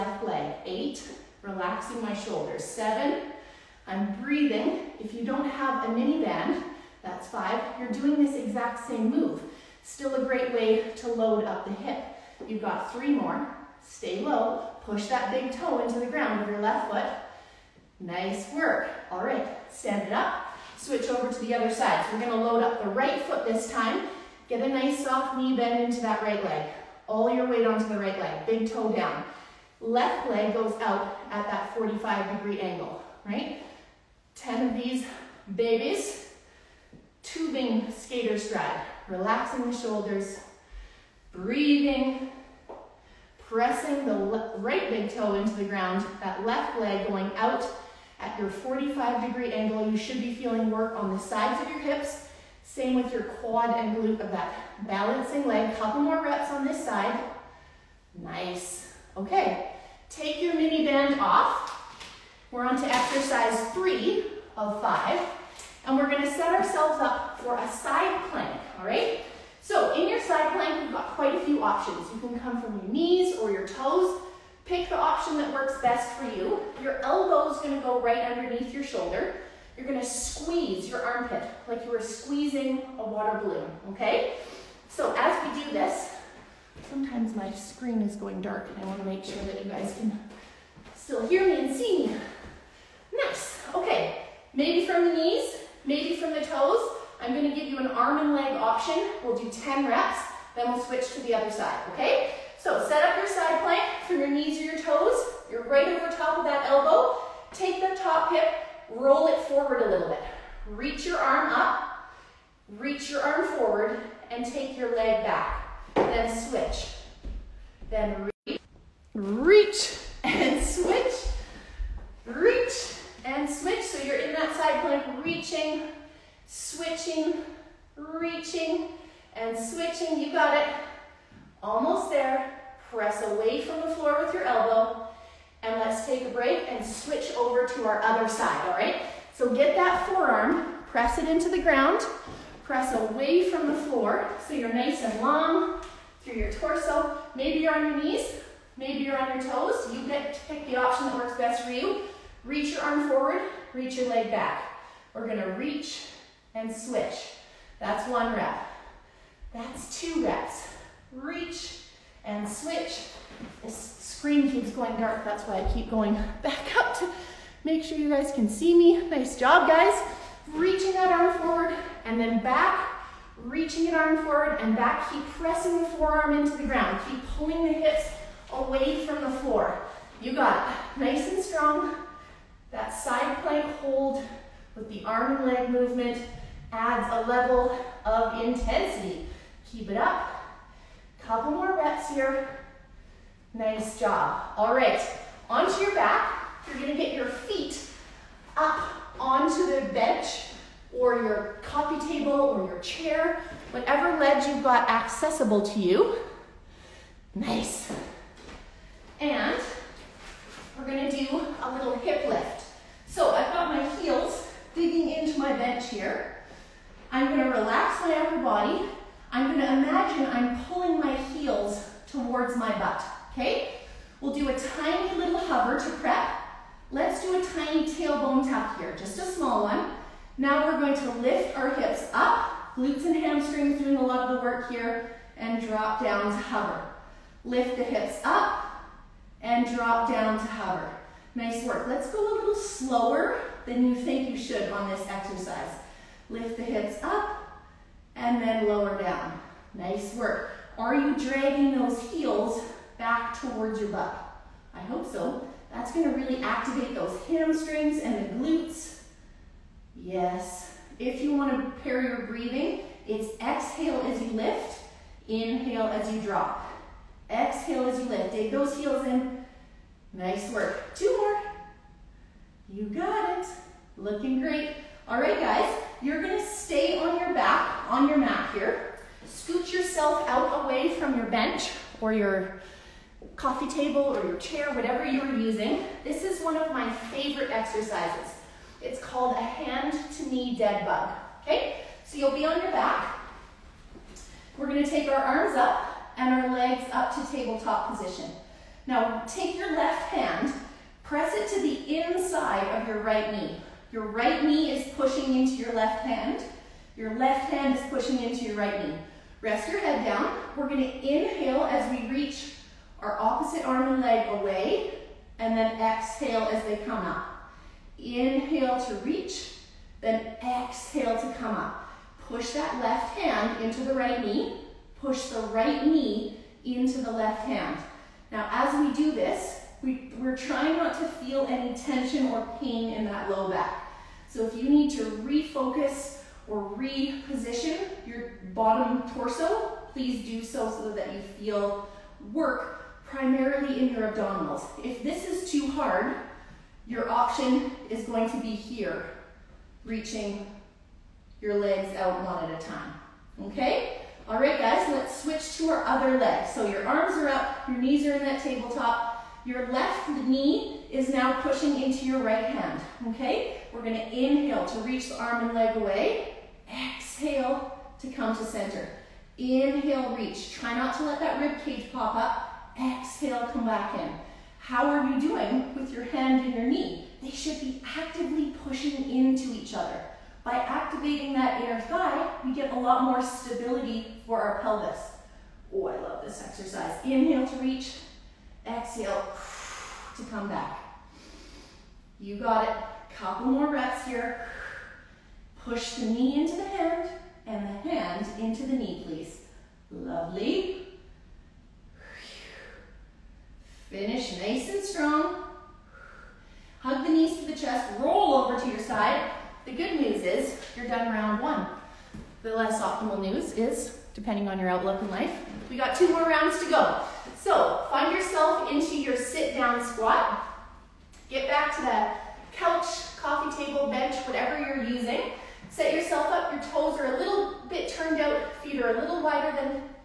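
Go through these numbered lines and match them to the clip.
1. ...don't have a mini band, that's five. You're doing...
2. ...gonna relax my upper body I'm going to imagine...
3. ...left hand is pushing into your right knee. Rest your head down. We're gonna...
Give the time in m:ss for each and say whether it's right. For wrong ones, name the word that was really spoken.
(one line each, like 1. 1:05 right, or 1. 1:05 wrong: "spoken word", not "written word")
1. 0:05 right
2. 3:37 right
3. 5:07 right.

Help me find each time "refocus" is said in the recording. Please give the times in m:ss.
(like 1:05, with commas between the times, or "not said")
5:35.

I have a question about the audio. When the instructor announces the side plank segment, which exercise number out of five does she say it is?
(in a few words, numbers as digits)
3.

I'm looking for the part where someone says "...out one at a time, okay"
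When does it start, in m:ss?
5:51.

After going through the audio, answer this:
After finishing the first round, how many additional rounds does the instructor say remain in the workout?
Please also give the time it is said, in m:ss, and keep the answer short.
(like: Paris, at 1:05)
2, at 6:55.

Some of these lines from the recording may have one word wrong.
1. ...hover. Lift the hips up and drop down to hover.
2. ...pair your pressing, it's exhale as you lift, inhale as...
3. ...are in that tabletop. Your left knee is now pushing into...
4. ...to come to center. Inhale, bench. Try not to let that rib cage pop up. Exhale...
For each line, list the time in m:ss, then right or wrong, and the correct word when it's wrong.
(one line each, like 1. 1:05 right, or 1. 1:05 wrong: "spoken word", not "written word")
1. 3:56 right
2. 4:21 wrong: "breathing", not "pressing"
3. 5:58 right
4. 6:07 wrong: "reach", not "bench".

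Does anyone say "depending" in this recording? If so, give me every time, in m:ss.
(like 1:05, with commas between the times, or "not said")
6:54.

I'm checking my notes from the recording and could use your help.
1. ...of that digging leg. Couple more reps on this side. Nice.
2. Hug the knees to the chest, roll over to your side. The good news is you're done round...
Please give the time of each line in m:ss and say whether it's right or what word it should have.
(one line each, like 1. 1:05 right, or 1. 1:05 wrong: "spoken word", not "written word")
1. 0:54 wrong: "balancing", not "digging"
2. 6:46 right.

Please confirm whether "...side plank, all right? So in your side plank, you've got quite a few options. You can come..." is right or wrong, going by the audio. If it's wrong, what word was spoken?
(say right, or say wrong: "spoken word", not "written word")
right.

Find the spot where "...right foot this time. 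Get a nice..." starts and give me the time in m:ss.
0:22.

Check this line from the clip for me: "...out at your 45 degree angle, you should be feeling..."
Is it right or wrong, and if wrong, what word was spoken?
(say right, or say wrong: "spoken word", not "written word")
right.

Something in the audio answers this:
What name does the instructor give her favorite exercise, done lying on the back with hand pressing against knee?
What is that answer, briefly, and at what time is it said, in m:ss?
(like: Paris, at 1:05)
hand to knee dead bug, at 4:49.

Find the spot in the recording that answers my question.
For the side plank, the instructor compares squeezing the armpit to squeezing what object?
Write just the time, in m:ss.
1:23.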